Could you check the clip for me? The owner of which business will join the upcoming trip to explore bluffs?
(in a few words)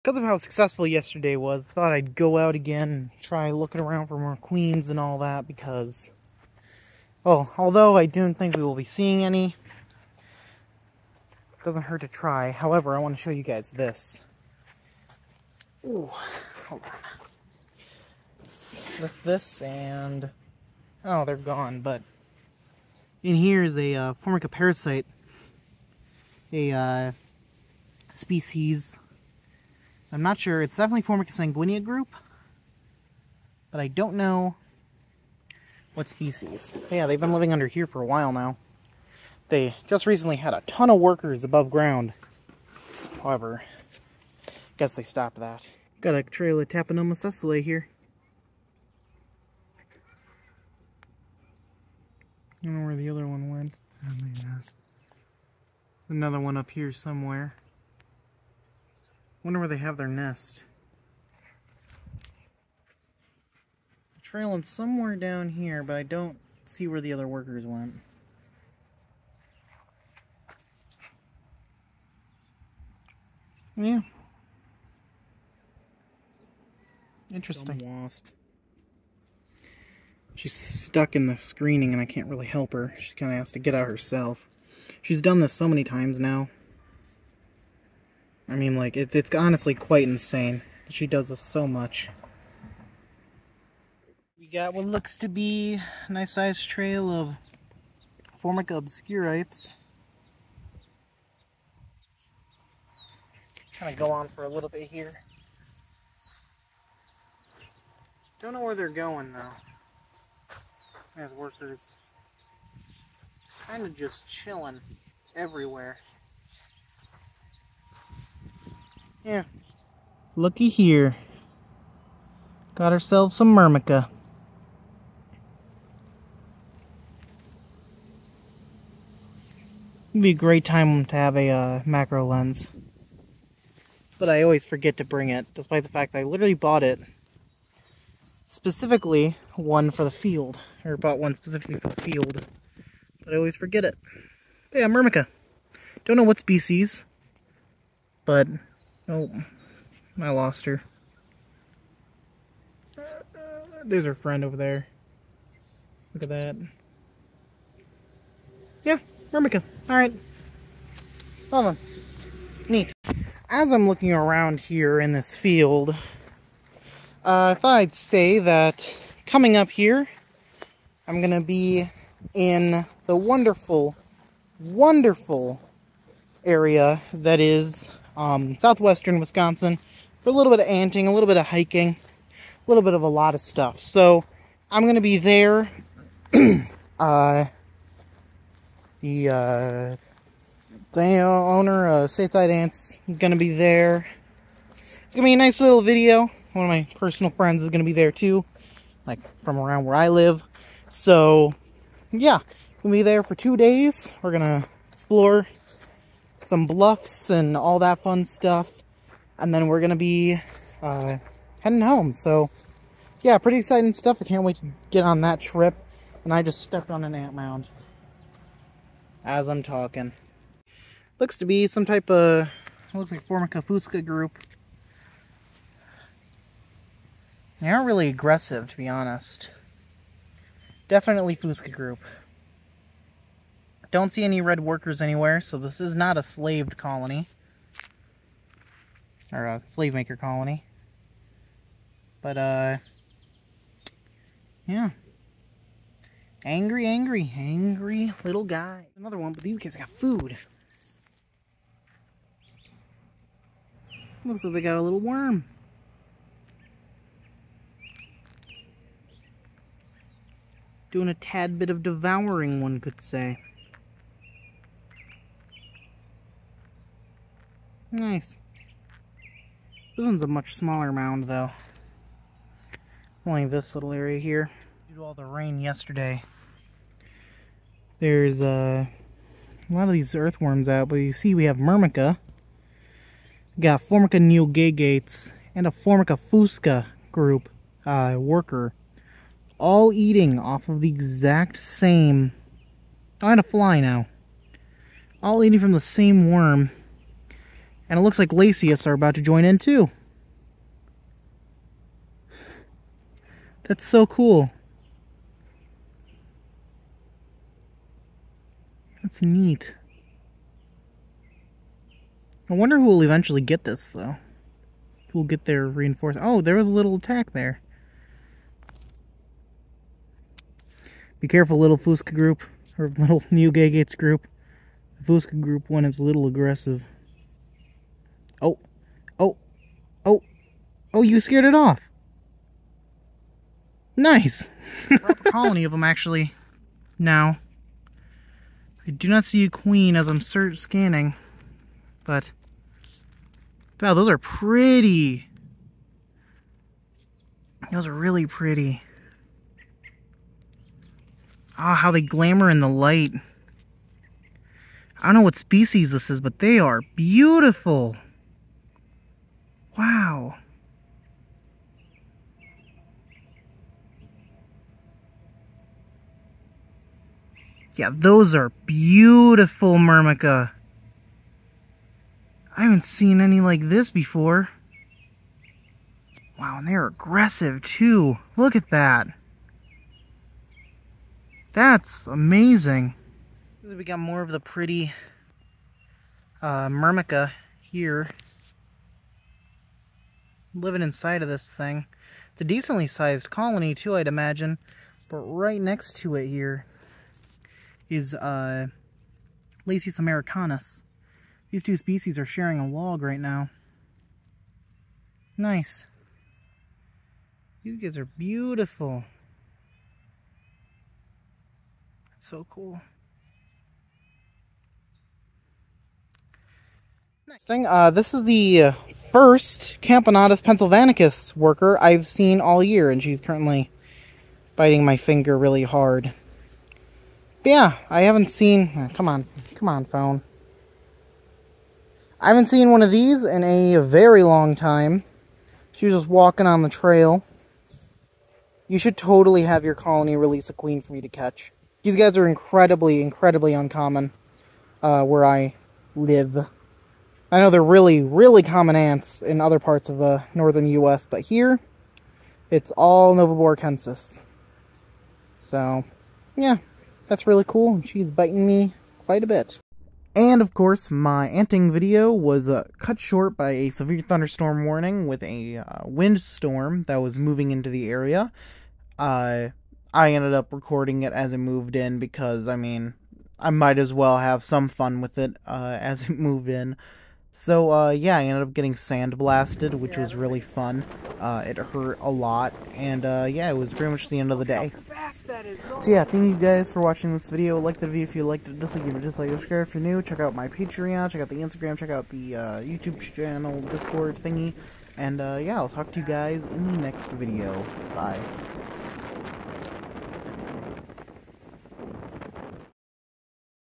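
Stateside Ants.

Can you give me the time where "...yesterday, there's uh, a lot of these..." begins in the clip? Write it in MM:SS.
04:35.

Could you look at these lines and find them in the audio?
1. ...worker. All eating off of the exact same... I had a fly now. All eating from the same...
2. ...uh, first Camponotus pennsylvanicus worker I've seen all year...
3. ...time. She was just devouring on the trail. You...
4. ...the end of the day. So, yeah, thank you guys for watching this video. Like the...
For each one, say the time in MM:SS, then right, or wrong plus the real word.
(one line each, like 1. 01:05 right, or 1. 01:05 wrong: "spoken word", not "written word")
1. 04:48 right
2. 06:58 right
3. 07:14 wrong: "walking", not "devouring"
4. 08:04 right.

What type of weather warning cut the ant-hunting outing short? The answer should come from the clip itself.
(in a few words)
severe thunderstorm warning.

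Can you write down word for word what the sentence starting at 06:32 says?
It's a decently sized colony too, I'd imagine.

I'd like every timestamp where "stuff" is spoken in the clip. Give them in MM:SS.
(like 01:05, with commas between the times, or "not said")
03:03, 03:28, 03:33.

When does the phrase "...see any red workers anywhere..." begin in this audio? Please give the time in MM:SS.
03:54.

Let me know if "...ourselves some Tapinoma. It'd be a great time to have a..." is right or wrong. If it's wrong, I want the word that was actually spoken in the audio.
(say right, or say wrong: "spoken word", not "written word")
wrong: "Myrmica", not "Tapinoma".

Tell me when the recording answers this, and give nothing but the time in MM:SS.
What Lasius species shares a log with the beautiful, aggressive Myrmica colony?
06:39.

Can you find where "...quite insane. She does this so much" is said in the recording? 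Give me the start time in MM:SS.
01:29.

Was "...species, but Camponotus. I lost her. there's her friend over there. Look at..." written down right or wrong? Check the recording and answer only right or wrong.
wrong.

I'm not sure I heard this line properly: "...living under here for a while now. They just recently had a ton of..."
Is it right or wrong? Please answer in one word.
right.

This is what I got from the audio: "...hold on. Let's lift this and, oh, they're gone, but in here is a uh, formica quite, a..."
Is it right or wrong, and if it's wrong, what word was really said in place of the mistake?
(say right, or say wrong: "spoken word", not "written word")
wrong: "parasite", not "quite".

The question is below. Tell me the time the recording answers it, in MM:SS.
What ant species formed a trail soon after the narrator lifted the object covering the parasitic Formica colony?
00:46.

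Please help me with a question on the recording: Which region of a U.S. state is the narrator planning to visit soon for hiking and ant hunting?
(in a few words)
southwestern Wisconsin.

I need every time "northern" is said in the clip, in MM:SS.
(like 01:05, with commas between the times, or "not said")
07:30.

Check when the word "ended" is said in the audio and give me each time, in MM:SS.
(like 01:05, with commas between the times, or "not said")
07:50, 07:58.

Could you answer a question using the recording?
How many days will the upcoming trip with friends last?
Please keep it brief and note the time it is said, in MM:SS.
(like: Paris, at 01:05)
2, at 03:23.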